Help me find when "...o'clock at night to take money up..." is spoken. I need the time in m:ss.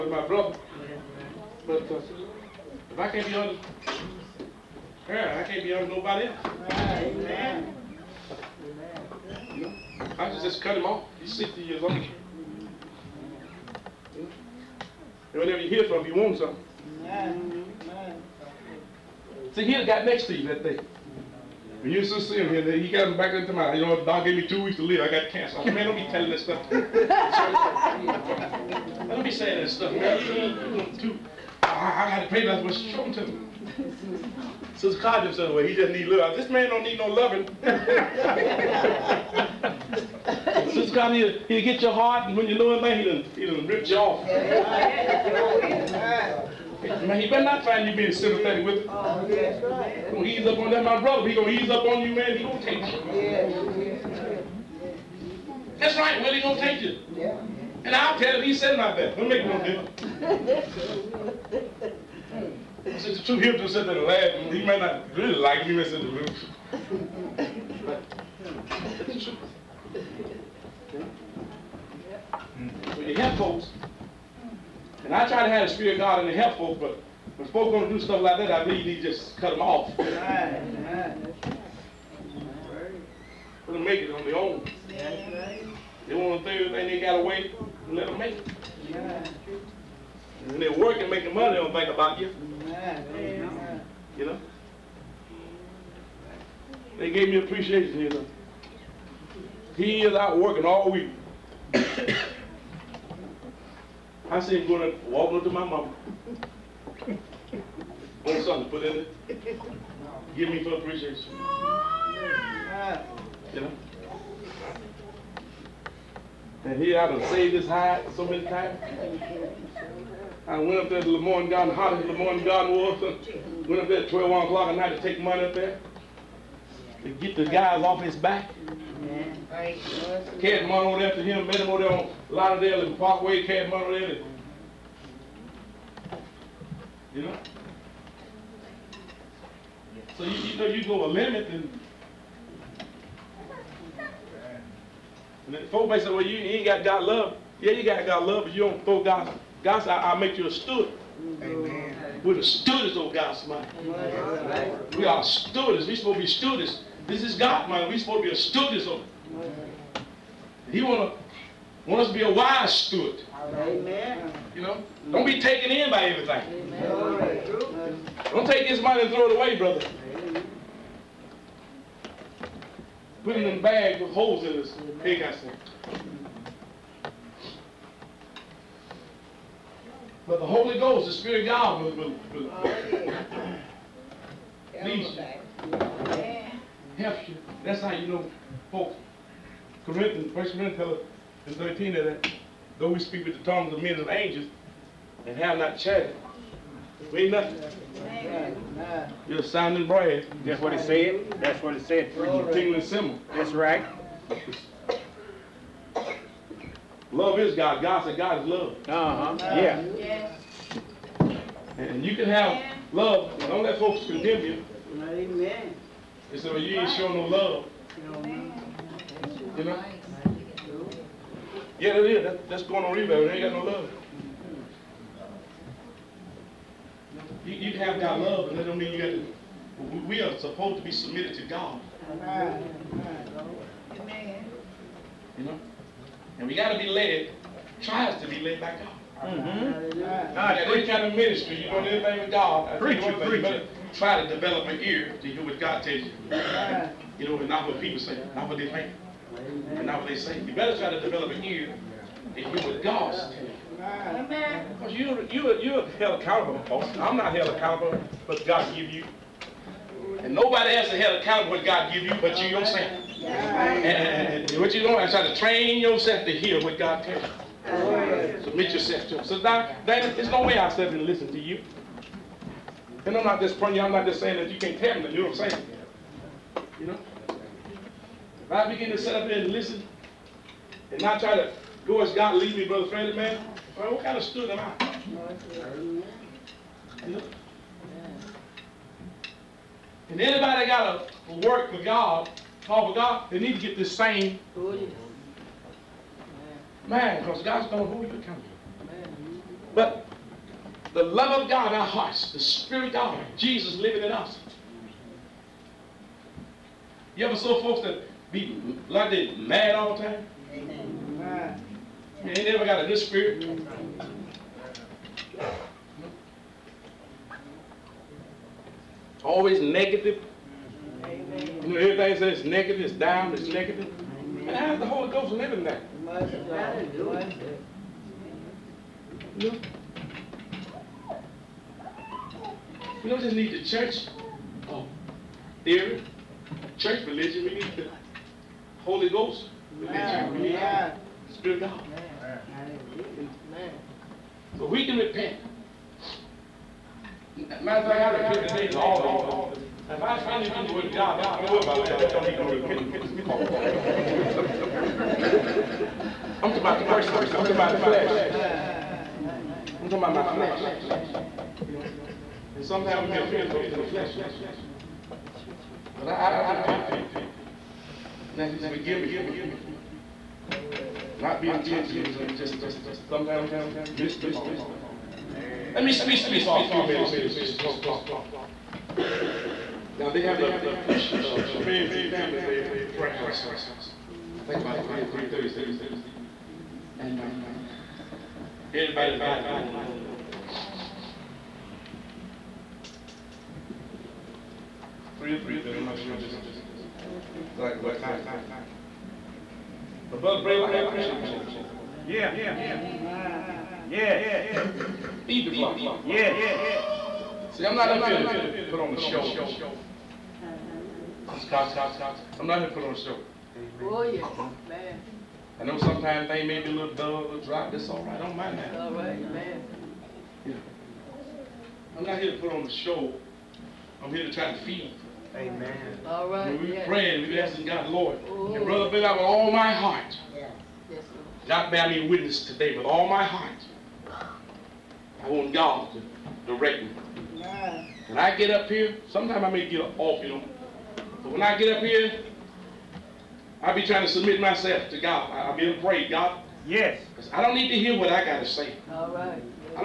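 2:04.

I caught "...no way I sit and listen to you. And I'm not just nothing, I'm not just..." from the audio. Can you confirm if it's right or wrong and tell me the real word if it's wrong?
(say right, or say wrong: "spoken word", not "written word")
wrong: "praying", not "nothing".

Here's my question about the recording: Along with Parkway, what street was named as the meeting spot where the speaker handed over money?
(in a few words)
Lauderdale.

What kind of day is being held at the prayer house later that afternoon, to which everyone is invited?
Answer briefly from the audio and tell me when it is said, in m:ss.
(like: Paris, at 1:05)
Friends and family day, at 6:21.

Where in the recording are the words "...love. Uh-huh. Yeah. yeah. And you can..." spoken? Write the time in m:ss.
3:28.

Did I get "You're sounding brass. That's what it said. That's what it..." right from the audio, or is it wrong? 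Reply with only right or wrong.
right.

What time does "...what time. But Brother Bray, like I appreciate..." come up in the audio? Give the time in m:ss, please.
6:37.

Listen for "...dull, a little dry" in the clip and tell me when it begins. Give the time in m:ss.
6:56.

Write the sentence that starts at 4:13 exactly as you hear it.
Because you, you, you're held accountable.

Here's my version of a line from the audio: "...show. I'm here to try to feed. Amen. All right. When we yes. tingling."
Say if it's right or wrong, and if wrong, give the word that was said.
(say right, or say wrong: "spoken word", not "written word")
wrong: "praying", not "tingling".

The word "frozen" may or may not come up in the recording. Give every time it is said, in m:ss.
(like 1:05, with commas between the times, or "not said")
not said.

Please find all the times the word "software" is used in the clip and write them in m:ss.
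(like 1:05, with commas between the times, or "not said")
not said.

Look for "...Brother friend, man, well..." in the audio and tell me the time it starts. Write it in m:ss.
4:42.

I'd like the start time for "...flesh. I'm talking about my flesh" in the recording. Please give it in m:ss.
5:57.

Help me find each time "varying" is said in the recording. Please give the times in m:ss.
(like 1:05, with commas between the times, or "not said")
not said.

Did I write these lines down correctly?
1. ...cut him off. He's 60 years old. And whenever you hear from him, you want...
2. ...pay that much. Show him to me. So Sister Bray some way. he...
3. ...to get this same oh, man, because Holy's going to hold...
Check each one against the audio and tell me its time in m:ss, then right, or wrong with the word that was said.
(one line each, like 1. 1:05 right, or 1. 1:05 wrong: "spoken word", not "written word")
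1. 0:10 right
2. 0:32 wrong: "Codger", not "Bray"
3. 4:53 wrong: "God", not "Holy".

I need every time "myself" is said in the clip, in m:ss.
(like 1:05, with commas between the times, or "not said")
7:24.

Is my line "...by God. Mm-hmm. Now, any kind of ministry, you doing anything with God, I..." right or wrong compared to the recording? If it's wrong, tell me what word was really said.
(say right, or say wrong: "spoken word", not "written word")
right.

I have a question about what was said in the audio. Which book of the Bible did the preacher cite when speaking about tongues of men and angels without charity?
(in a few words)
First Corinthians.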